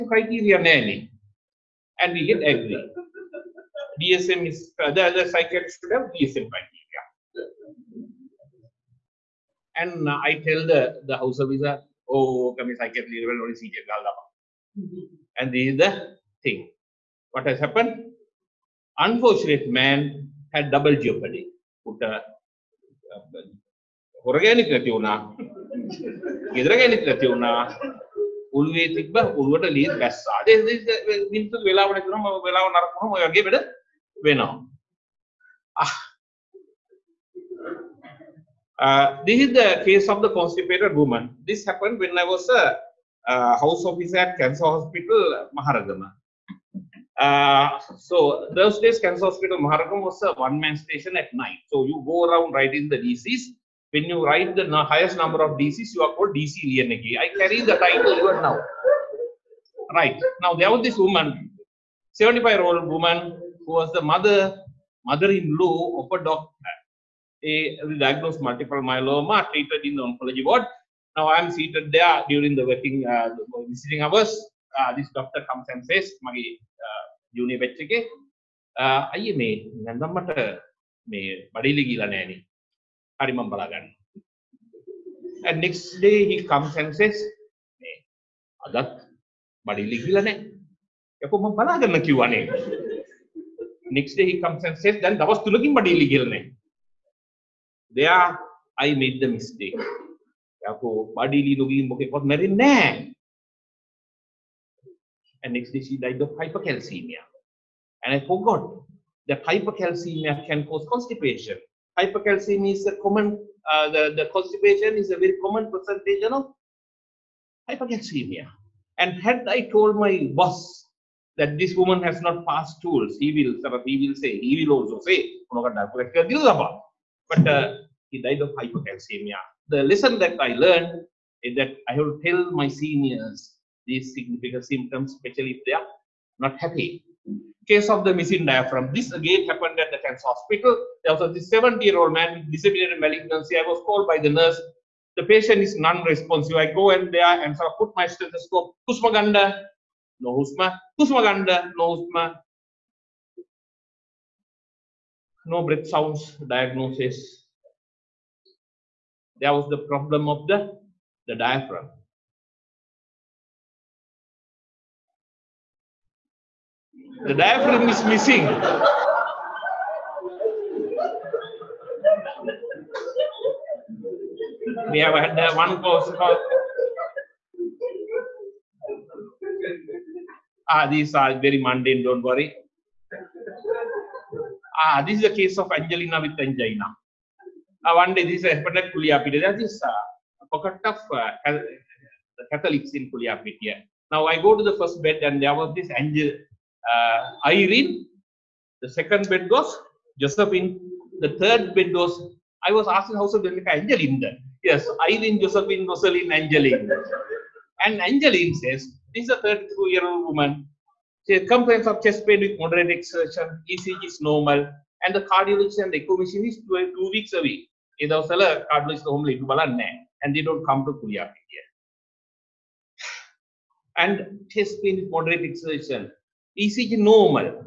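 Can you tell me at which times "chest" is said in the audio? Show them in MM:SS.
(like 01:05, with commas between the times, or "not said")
03:32, 03:44.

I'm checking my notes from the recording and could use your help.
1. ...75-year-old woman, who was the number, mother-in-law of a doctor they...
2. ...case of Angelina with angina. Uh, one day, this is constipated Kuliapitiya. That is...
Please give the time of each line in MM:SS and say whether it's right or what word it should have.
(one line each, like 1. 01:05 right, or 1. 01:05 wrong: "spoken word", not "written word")
1. 01:02 wrong: "mother", not "number"
2. 03:05 wrong: "expected", not "constipated".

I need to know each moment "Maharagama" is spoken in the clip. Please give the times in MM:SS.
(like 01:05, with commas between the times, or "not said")
00:45, 00:49.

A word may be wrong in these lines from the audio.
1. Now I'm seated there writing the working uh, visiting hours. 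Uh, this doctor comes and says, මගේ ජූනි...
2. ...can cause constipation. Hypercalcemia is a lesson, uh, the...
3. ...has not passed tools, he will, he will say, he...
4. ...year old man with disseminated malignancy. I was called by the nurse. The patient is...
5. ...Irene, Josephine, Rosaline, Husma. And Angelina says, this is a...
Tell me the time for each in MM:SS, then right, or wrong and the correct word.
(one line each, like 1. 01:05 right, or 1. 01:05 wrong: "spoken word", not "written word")
1. 01:11 wrong: "during", not "writing"
2. 01:50 wrong: "common", not "lesson"
3. 02:02 right
4. 02:21 right
5. 03:25 wrong: "Angelina", not "Husma".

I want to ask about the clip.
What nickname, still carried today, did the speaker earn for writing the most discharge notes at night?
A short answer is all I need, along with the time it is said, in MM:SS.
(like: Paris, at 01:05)
DC Lianagi, at 00:56.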